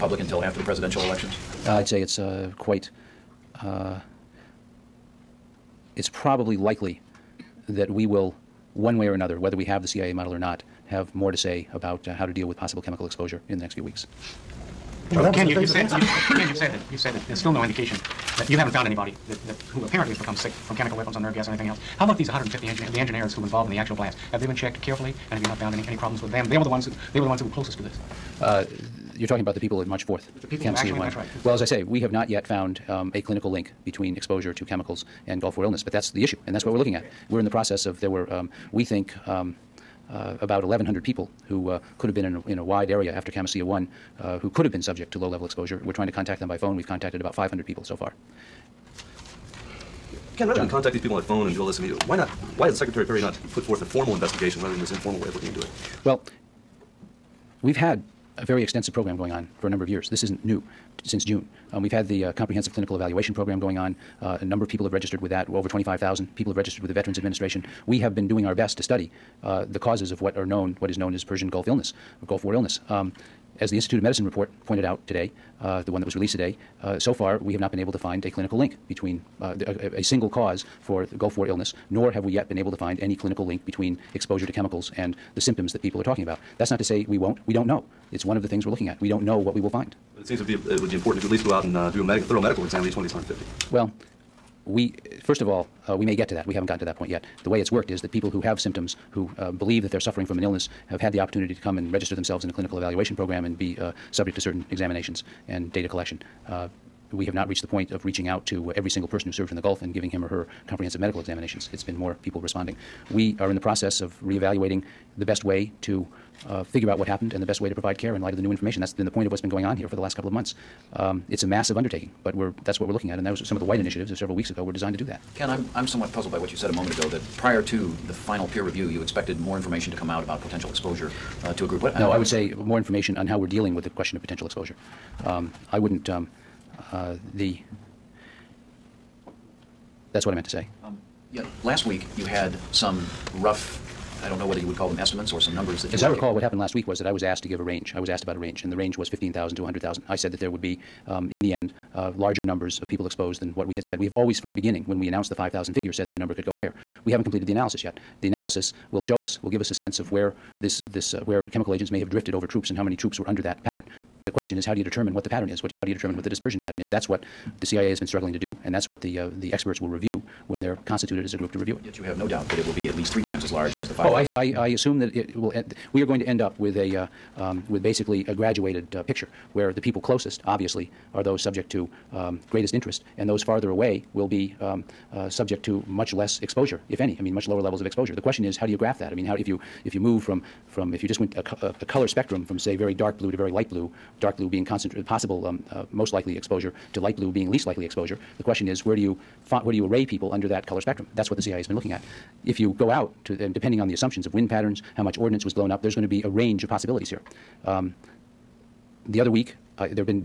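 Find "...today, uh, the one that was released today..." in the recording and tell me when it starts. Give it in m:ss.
1:15.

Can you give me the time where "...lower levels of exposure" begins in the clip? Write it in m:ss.
3:07.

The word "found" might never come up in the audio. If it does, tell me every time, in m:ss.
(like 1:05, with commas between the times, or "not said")
0:18, 0:25, 0:32.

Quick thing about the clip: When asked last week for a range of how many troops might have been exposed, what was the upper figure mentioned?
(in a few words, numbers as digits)
100,000.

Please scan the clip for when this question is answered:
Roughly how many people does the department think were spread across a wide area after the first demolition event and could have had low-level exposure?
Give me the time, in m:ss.
0:40.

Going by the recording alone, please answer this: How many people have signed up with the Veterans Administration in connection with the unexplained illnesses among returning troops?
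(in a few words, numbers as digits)
Over 25,000.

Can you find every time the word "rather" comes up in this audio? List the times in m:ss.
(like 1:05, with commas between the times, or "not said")
0:50, 0:54.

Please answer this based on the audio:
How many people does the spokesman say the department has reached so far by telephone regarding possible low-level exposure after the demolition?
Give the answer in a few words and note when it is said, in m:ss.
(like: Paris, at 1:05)
500, at 0:47.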